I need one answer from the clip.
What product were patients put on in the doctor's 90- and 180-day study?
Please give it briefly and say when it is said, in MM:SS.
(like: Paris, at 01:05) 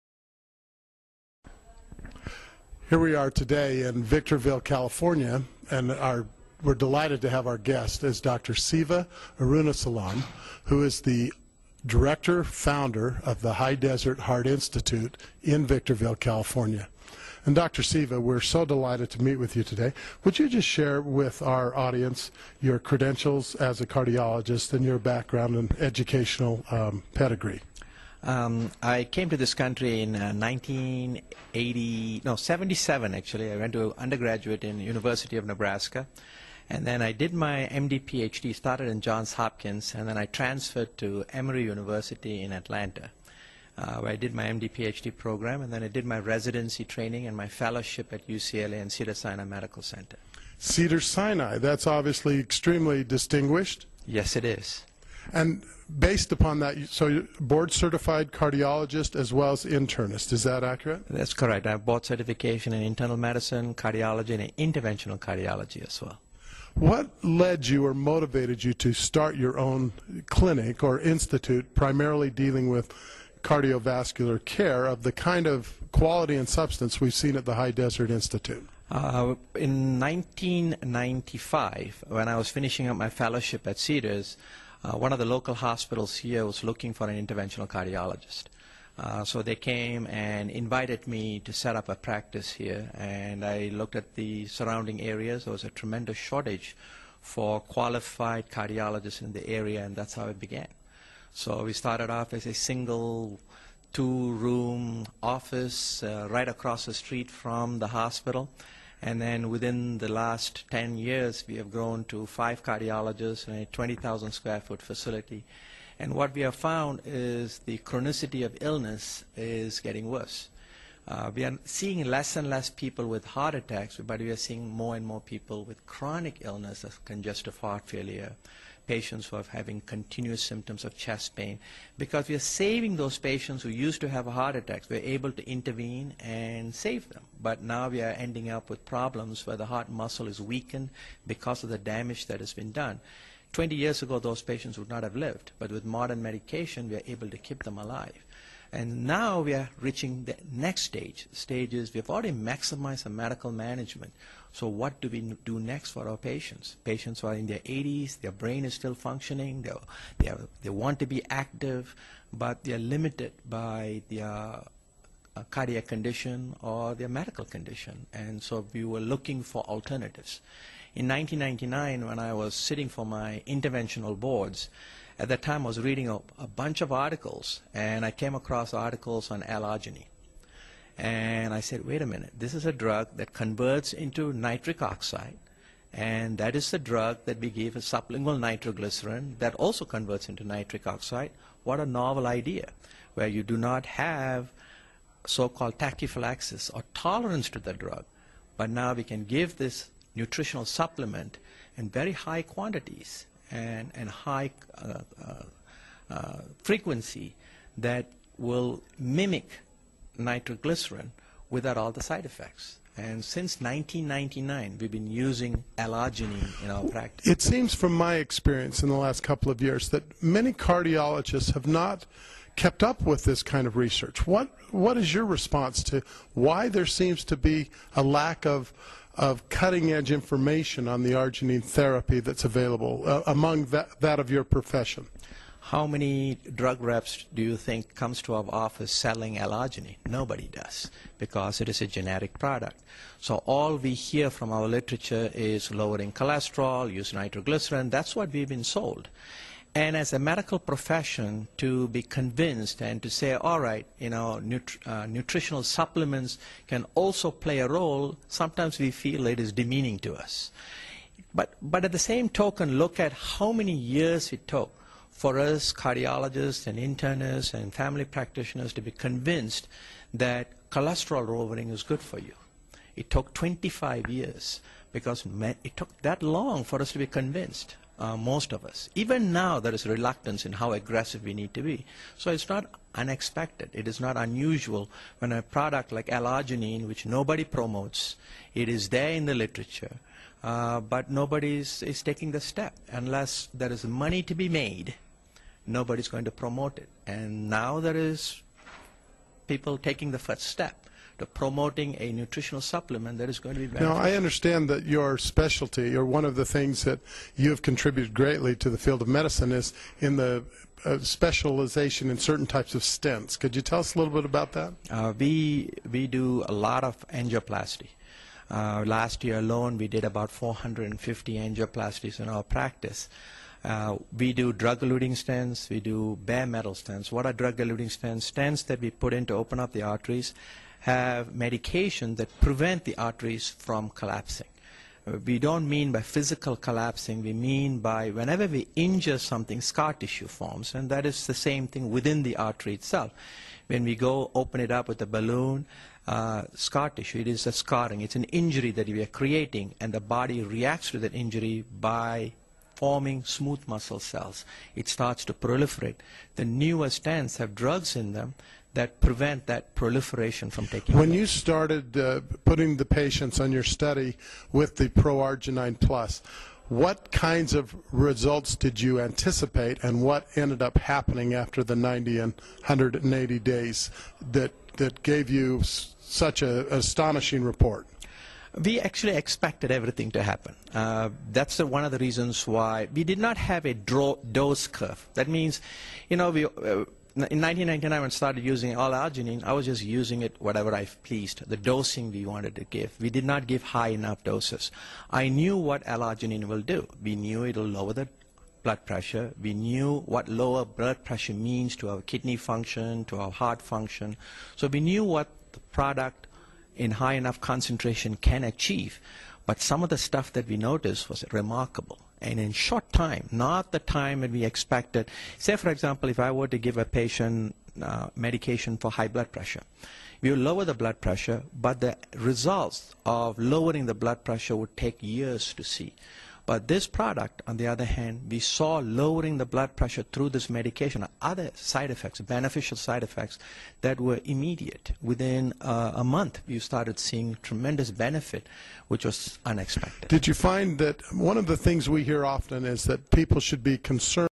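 ProArgi-9 Plus, at 06:04.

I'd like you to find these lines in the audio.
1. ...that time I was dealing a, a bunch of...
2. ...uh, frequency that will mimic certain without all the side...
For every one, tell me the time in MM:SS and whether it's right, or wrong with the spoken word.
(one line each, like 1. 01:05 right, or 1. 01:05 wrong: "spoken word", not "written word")
1. 02:55 wrong: "reading", not "dealing"
2. 03:26 wrong: "nitroglycerin", not "certain".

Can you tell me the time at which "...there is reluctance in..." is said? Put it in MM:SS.
04:39.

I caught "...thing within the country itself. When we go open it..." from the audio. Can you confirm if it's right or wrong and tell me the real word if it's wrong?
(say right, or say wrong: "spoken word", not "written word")
wrong: "artery", not "country".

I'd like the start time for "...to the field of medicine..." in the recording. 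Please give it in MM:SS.
05:08.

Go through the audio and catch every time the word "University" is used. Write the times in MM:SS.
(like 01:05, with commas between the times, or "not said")
00:34, 00:41.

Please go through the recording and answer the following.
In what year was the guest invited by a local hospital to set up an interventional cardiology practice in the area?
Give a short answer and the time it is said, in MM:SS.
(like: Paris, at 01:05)
1995, at 01:19.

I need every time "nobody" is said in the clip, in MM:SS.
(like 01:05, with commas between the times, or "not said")
04:00, 04:47, 04:51, 04:55.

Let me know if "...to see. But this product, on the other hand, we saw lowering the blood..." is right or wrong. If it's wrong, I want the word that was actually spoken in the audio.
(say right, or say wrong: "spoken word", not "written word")
right.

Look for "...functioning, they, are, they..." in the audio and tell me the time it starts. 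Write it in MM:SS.
02:38.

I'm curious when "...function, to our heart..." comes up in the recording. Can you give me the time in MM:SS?
06:42.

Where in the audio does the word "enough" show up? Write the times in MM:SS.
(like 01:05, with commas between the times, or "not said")
06:33, 06:47.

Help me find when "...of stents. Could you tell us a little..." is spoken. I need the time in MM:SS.
05:12.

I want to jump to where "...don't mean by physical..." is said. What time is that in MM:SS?
05:35.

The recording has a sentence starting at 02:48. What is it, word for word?
And so we were looking for alternatives.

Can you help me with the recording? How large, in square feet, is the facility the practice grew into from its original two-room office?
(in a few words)
20,000 square feet.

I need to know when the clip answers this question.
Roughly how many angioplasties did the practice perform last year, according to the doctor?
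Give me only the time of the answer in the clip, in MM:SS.
05:20.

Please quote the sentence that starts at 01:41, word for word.
So we started off as a single two-room office uh, right across the street from the hospital.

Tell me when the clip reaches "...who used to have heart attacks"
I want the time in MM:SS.
02:13.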